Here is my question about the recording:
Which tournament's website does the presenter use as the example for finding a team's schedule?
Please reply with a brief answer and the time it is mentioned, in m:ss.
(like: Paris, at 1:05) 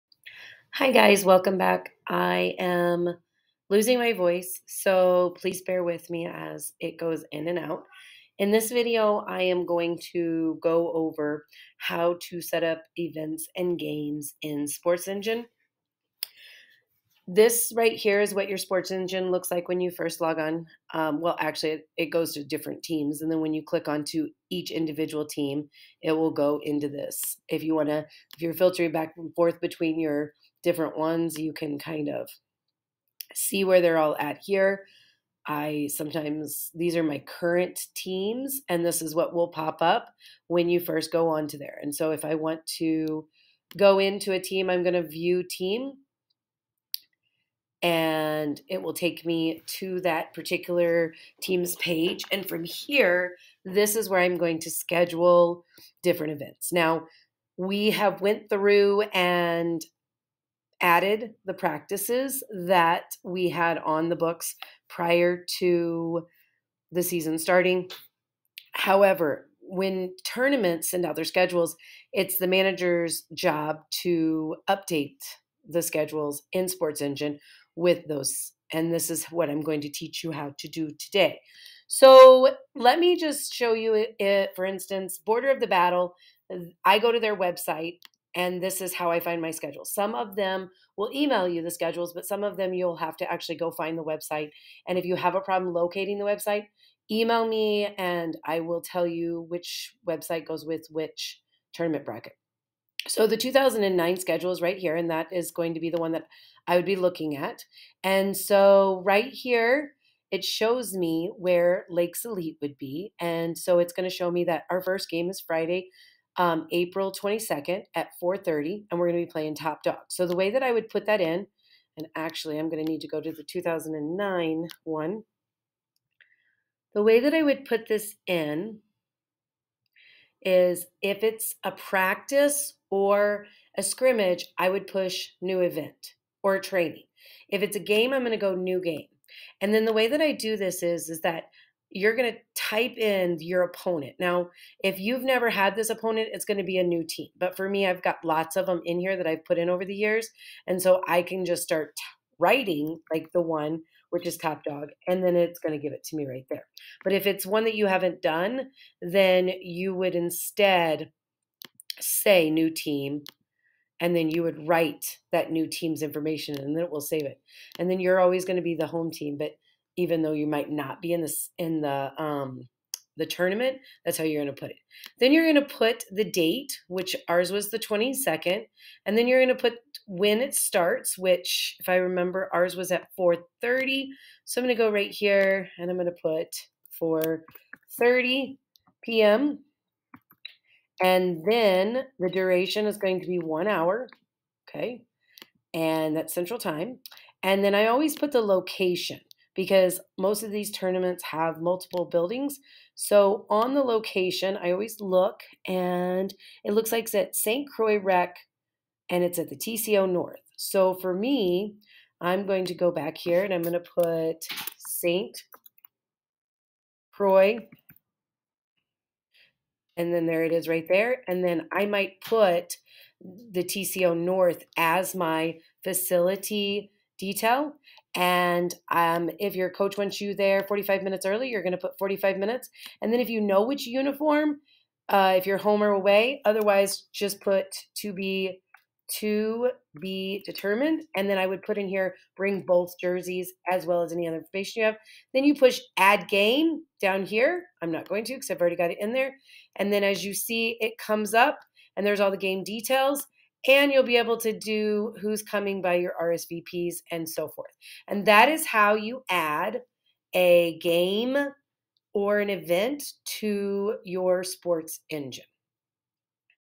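Border of the Battle, at 1:25.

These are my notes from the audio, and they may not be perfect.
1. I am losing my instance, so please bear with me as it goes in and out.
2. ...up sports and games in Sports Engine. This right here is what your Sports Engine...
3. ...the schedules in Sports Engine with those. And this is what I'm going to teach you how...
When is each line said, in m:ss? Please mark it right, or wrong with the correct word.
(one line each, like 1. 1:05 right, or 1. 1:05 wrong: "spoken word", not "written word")
1. 0:02 wrong: "voice", not "instance"
2. 0:12 wrong: "events", not "sports"
3. 1:15 right.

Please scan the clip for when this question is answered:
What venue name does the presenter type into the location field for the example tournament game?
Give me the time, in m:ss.
3:27.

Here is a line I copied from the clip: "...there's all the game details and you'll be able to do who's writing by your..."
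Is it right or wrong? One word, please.
wrong.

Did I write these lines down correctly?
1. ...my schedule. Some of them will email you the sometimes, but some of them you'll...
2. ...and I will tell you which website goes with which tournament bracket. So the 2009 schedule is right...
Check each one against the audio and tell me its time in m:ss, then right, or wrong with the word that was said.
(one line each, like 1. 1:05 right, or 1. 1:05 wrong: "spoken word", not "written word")
1. 1:29 wrong: "schedules", not "sometimes"
2. 1:37 right.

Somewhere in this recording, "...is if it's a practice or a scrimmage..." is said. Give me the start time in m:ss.
2:10.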